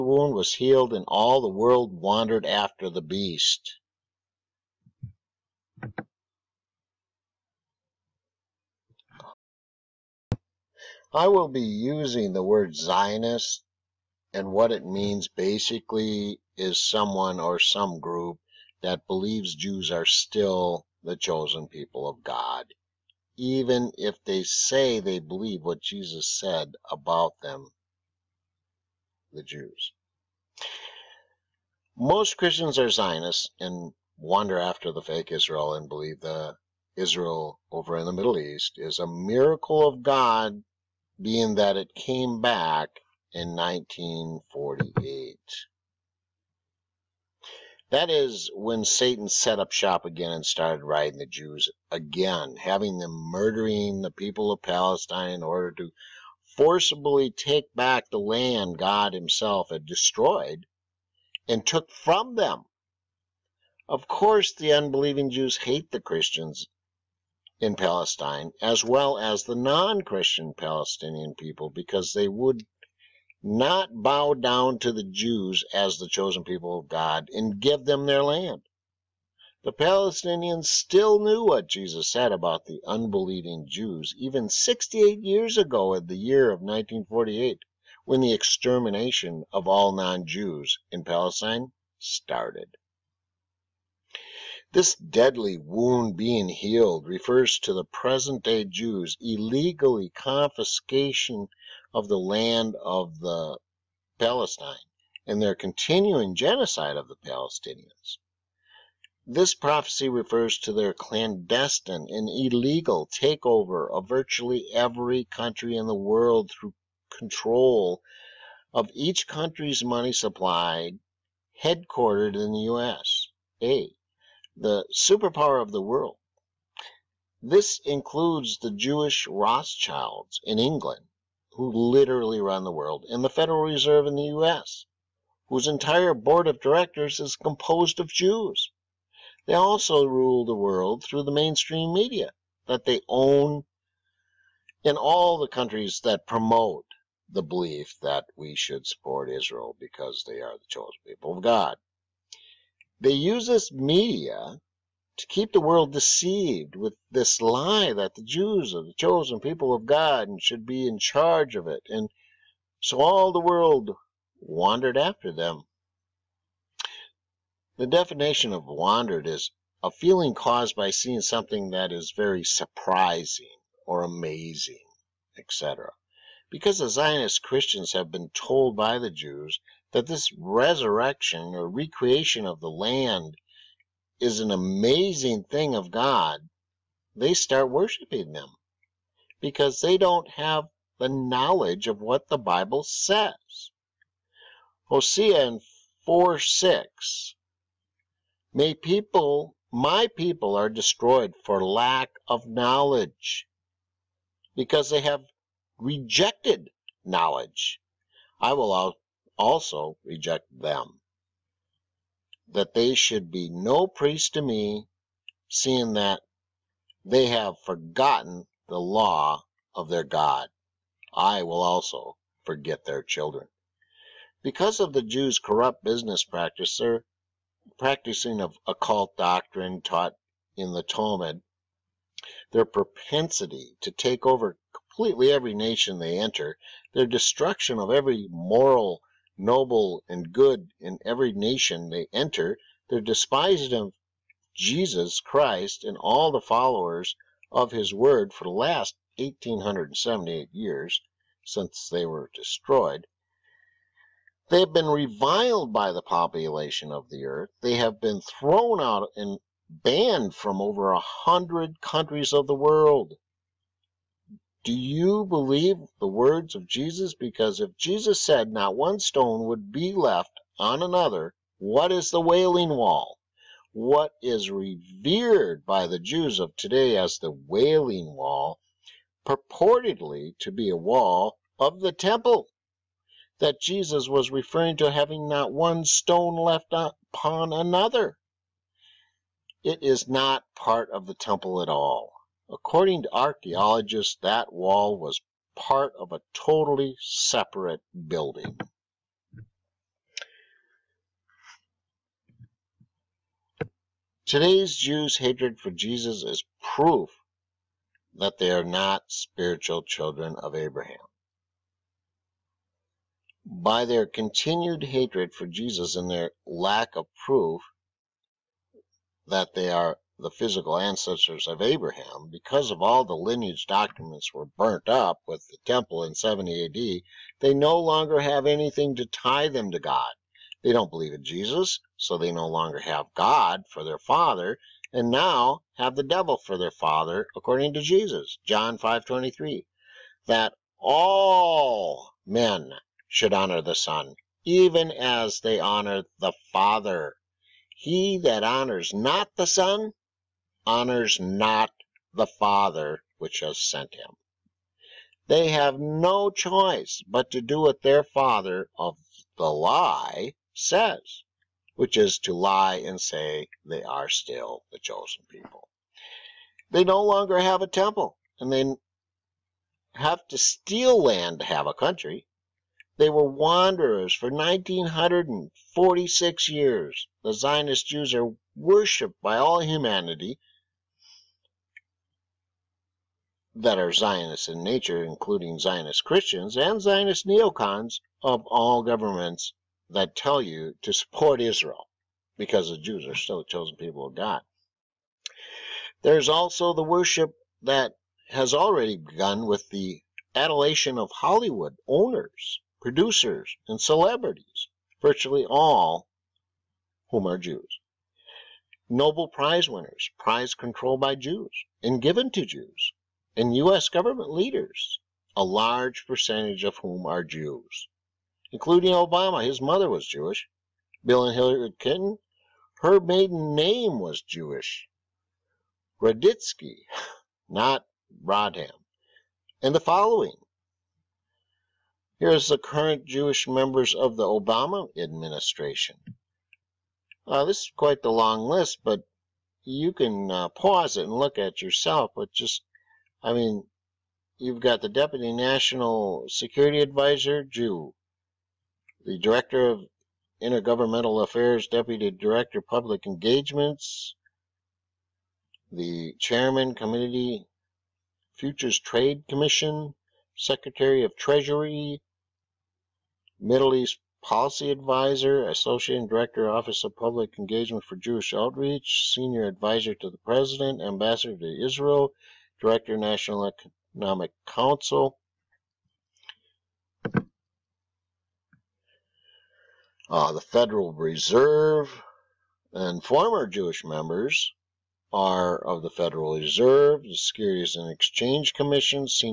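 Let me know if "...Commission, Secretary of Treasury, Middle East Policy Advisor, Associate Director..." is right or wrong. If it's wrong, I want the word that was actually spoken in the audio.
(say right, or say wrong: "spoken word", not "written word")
right.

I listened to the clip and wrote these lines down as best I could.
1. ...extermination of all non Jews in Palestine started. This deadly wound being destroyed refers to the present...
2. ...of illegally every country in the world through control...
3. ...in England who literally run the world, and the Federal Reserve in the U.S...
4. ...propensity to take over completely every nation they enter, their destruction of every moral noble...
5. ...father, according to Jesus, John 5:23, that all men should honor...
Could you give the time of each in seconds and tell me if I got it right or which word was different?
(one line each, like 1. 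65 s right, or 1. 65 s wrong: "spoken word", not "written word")
1. 88 s wrong: "healed", not "destroyed"
2. 113 s wrong: "virtually", not "illegally"
3. 130 s right
4. 232 s right
5. 336 s right.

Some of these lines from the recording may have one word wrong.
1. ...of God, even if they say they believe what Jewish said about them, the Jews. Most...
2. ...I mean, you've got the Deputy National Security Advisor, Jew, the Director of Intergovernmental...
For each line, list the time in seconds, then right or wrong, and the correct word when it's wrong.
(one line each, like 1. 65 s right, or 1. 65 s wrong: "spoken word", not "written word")
1. 22 s wrong: "Jesus", not "Jewish"
2. 443 s right.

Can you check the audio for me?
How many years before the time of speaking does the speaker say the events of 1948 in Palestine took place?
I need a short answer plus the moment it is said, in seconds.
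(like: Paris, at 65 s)
68, at 84 s.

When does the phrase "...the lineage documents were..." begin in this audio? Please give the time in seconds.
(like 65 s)
323 s.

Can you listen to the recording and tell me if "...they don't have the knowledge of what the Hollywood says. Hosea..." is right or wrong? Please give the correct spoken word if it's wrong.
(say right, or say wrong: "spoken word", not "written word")
wrong: "Bible", not "Hollywood".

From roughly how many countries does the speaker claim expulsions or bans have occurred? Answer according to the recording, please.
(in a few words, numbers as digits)
over a hundred.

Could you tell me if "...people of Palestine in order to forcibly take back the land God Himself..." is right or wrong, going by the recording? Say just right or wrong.
right.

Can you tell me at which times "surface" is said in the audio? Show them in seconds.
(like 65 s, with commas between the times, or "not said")
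not said.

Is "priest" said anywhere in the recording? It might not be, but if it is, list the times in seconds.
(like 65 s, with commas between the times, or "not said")
213 s.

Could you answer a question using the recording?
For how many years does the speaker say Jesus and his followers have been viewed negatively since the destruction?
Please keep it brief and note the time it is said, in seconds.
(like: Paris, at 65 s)
1878, at 249 s.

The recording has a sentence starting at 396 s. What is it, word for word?
There's also the worship that has already begun with the adulation of Hollywood owners, producers, and celebrities, virtually all whom are Jews.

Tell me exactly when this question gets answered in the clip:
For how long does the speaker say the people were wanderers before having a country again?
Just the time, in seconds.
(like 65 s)
374 s.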